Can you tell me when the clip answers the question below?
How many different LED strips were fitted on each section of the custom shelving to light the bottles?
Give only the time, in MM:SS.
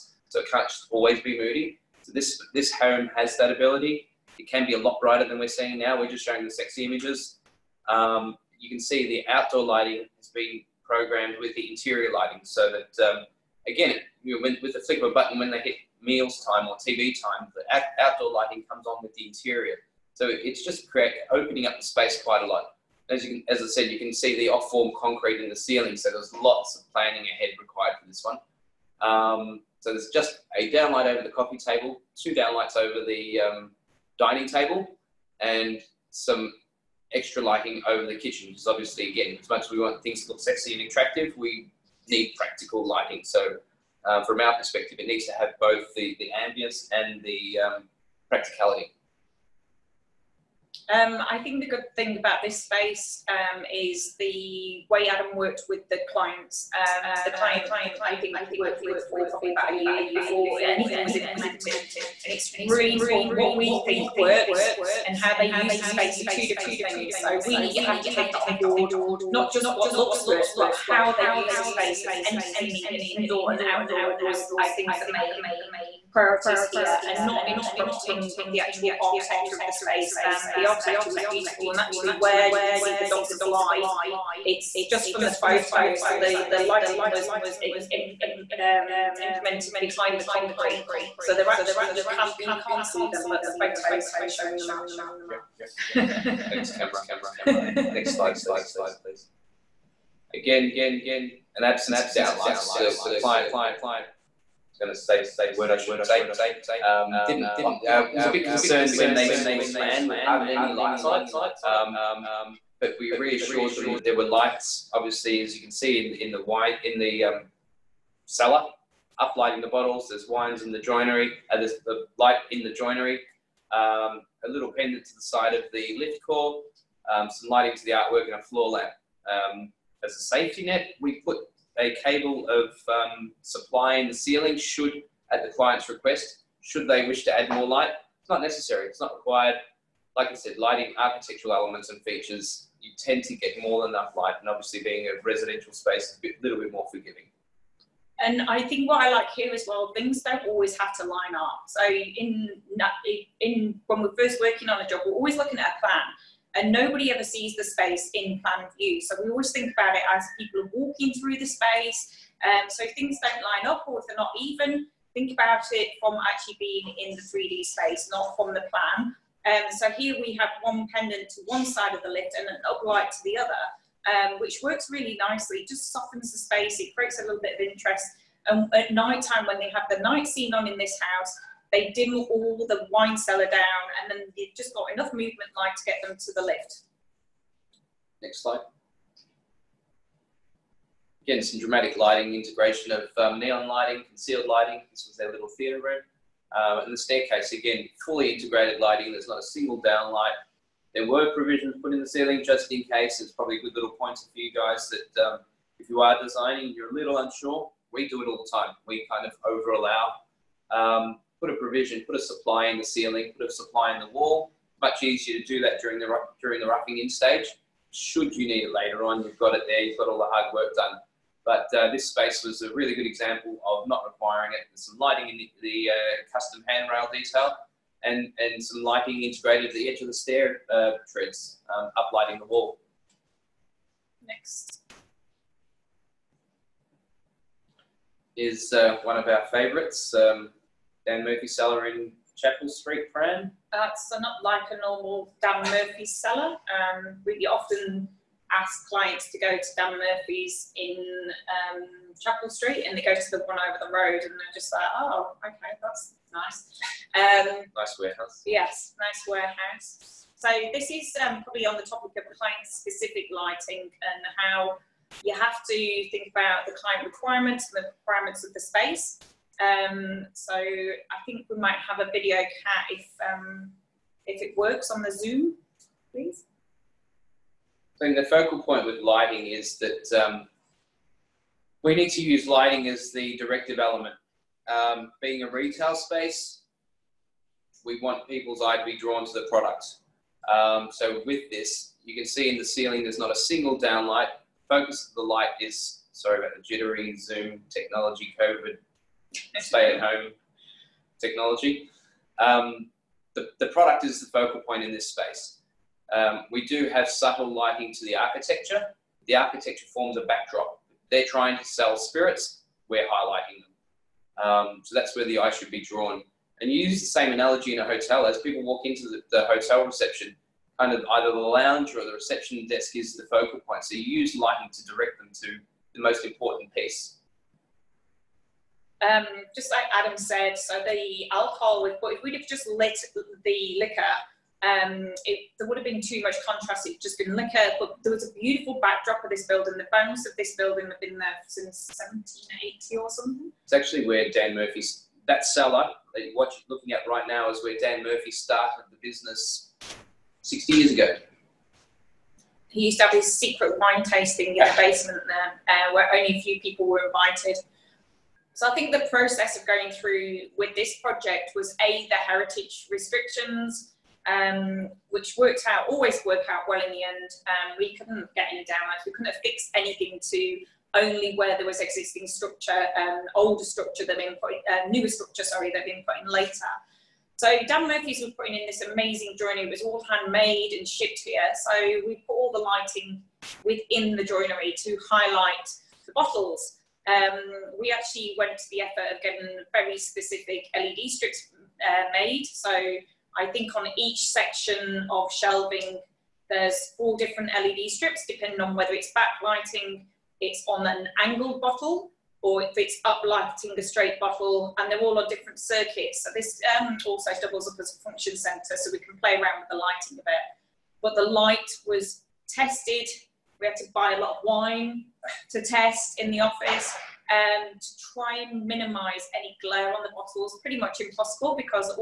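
06:36.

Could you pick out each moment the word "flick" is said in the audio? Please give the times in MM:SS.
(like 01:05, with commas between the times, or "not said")
00:14.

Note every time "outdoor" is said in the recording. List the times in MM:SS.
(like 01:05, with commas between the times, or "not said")
00:09, 00:18, 01:13.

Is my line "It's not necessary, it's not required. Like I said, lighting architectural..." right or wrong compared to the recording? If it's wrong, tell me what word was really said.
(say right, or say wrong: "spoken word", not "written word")
right.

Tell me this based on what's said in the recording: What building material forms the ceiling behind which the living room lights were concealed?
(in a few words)
off-form concrete.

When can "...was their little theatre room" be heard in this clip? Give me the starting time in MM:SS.
03:15.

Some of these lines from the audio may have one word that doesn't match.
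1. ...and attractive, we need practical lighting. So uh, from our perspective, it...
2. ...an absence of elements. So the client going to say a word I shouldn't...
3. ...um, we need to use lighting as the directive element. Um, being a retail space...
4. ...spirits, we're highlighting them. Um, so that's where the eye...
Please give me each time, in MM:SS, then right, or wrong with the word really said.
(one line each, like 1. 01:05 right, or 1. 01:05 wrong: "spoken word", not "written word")
1. 00:40 right
2. 01:41 wrong: "downlights", not "elements"
3. 04:40 right
4. 05:11 right.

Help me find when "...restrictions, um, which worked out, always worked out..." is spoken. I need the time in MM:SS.
06:02.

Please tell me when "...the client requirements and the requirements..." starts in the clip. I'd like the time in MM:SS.
04:26.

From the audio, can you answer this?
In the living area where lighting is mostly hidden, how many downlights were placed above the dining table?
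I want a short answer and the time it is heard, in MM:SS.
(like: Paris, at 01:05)
2, at 00:32.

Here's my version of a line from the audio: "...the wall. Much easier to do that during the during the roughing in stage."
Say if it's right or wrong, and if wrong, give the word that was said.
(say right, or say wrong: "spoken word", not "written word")
right.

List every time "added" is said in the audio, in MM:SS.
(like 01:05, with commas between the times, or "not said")
not said.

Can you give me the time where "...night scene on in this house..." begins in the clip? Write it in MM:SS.
03:00.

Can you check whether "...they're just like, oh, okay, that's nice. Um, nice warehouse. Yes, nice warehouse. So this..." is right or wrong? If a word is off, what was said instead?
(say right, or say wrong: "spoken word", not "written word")
right.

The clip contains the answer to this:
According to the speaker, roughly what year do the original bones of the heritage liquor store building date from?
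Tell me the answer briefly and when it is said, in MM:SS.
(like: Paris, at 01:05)
1780, at 05:42.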